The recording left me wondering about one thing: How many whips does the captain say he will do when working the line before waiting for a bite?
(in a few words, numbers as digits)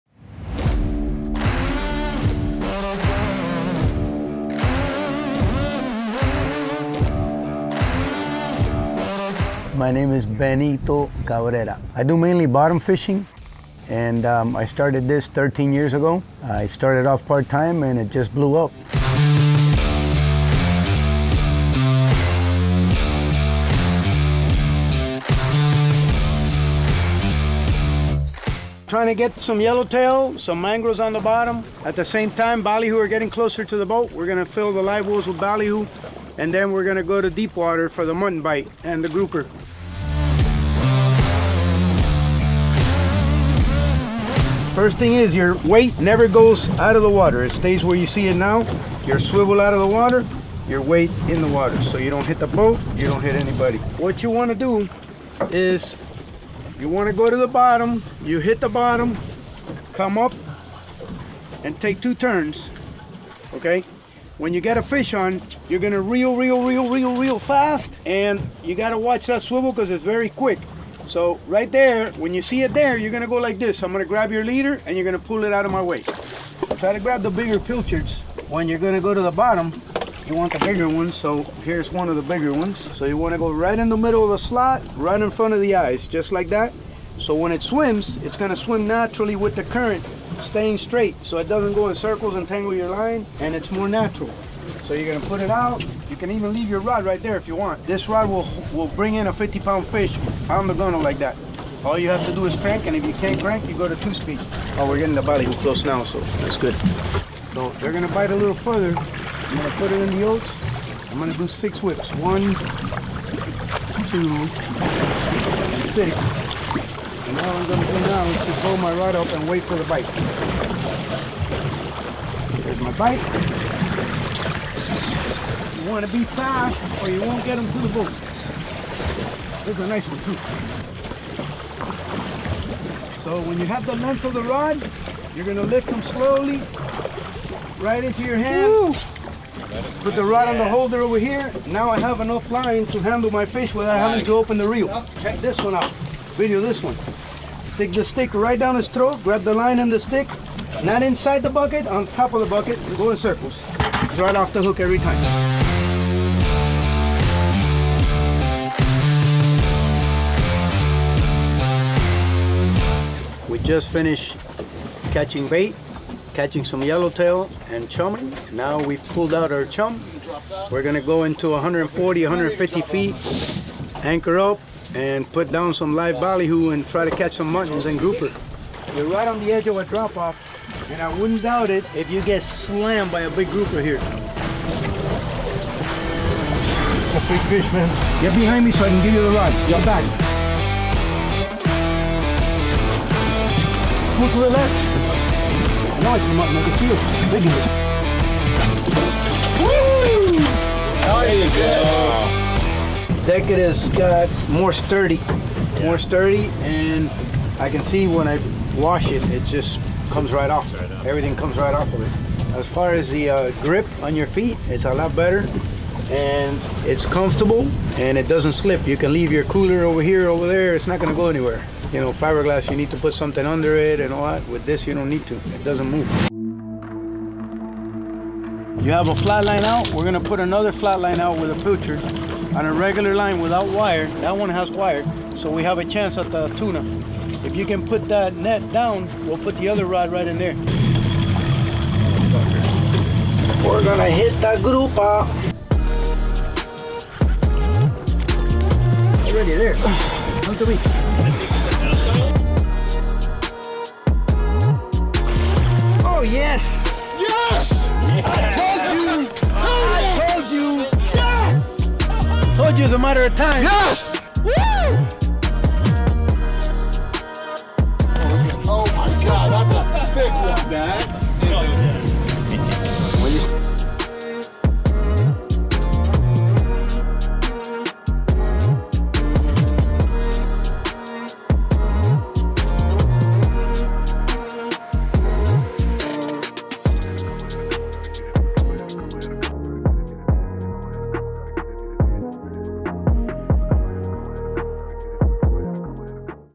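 6.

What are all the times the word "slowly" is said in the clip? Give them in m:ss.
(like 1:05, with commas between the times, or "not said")
2:16.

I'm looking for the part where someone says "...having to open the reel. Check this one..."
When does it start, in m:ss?
2:23.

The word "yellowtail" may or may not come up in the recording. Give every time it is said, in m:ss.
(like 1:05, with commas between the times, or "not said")
0:29, 2:46.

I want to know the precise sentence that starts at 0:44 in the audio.
First thing is your weight never goes out of the water.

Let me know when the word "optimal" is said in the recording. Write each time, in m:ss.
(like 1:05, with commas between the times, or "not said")
not said.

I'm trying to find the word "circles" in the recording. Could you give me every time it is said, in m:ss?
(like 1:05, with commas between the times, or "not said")
1:31, 2:33.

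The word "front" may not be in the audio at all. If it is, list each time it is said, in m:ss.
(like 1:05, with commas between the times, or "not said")
1:25.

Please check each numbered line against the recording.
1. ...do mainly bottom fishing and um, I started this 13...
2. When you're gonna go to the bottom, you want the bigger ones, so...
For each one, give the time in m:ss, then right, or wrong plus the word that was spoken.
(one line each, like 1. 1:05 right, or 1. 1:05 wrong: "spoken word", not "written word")
1. 0:12 right
2. 1:18 right.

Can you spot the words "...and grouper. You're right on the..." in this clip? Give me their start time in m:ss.
2:57.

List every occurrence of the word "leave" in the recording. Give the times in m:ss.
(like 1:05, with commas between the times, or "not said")
1:36, 3:39.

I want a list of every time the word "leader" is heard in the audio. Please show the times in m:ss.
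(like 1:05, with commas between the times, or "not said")
1:14.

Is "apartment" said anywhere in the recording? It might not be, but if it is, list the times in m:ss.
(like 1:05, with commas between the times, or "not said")
not said.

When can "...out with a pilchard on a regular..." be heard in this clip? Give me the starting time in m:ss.
3:51.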